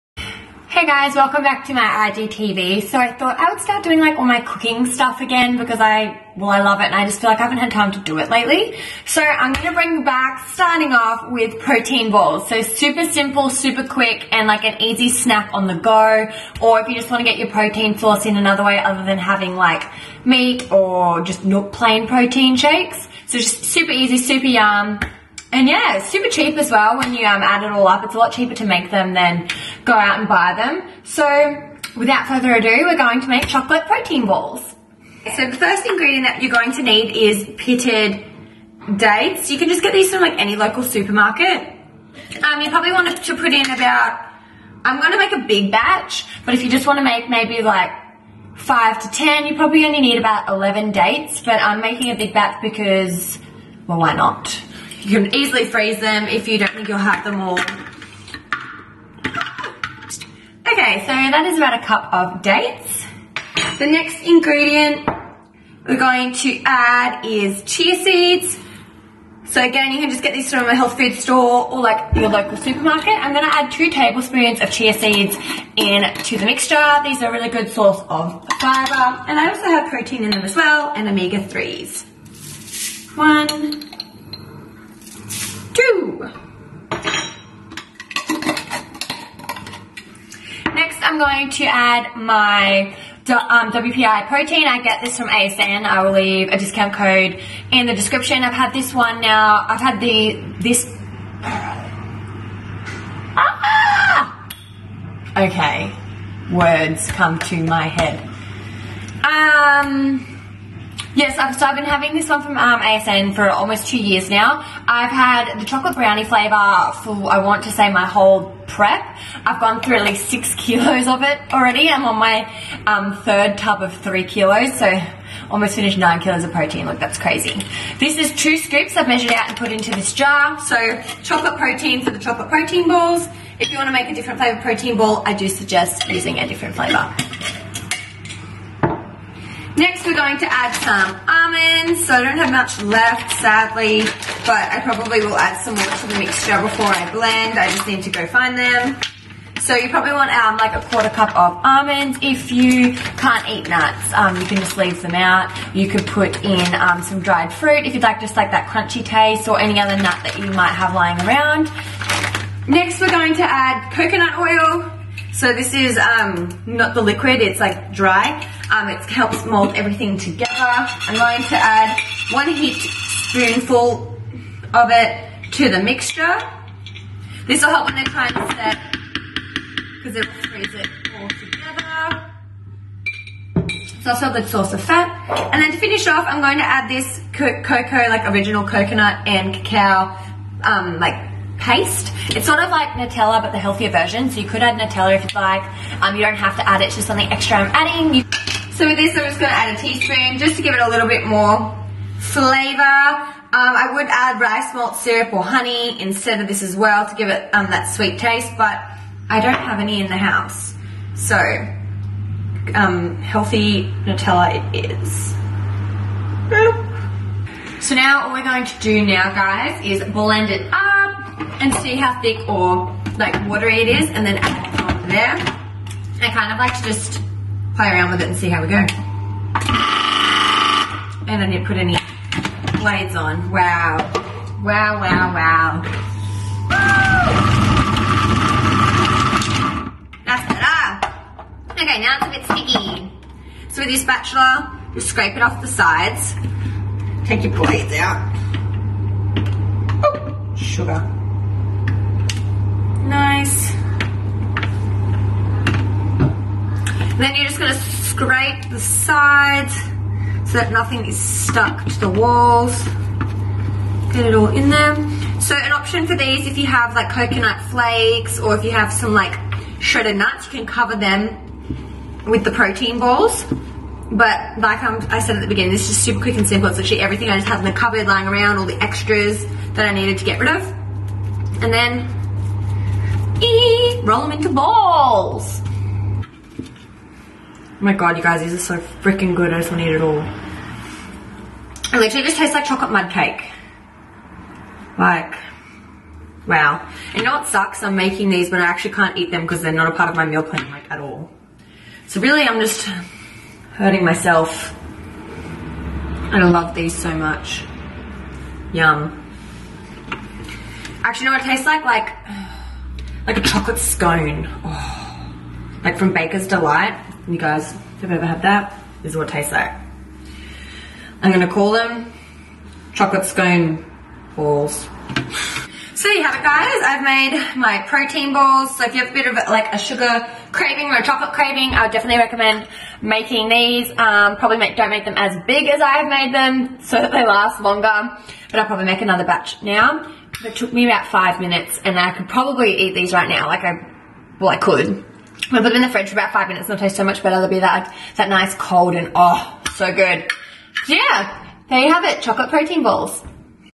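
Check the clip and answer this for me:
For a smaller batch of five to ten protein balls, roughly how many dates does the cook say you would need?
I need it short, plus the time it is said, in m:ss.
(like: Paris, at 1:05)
11, at 0:50.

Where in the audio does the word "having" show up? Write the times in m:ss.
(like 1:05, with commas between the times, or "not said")
0:19, 1:51.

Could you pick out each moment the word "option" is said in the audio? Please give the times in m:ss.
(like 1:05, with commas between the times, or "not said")
4:25.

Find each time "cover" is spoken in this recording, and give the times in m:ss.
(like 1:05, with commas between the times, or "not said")
4:30.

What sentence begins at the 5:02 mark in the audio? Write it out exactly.
So really, I'm just hurting myself.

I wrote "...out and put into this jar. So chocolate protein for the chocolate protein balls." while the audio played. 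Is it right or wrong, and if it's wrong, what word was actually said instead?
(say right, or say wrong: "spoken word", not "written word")
right.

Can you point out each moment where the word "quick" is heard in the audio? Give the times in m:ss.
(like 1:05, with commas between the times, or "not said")
0:13, 4:36.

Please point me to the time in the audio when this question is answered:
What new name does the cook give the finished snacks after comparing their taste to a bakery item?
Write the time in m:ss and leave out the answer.
5:22.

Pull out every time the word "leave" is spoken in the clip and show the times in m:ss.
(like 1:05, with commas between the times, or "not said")
1:36, 2:34.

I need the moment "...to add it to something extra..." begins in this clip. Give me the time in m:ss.
3:16.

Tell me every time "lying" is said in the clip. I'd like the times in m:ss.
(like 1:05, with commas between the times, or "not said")
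2:40, 4:38.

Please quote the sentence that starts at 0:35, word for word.
So the first ingredient that you're going to need is pitted dates.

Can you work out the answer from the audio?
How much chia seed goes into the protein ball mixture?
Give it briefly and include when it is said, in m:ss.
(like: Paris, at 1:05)
2 tablespoons, at 1:13.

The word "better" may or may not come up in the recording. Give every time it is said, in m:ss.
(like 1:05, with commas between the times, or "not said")
4:00, 5:47.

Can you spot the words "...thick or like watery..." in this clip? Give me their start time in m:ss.
3:42.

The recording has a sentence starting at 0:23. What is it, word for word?
So just super easy, super yum.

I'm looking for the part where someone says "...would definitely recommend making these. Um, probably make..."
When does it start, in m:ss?
5:31.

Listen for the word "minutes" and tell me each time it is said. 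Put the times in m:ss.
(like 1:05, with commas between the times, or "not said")
5:41, 5:46.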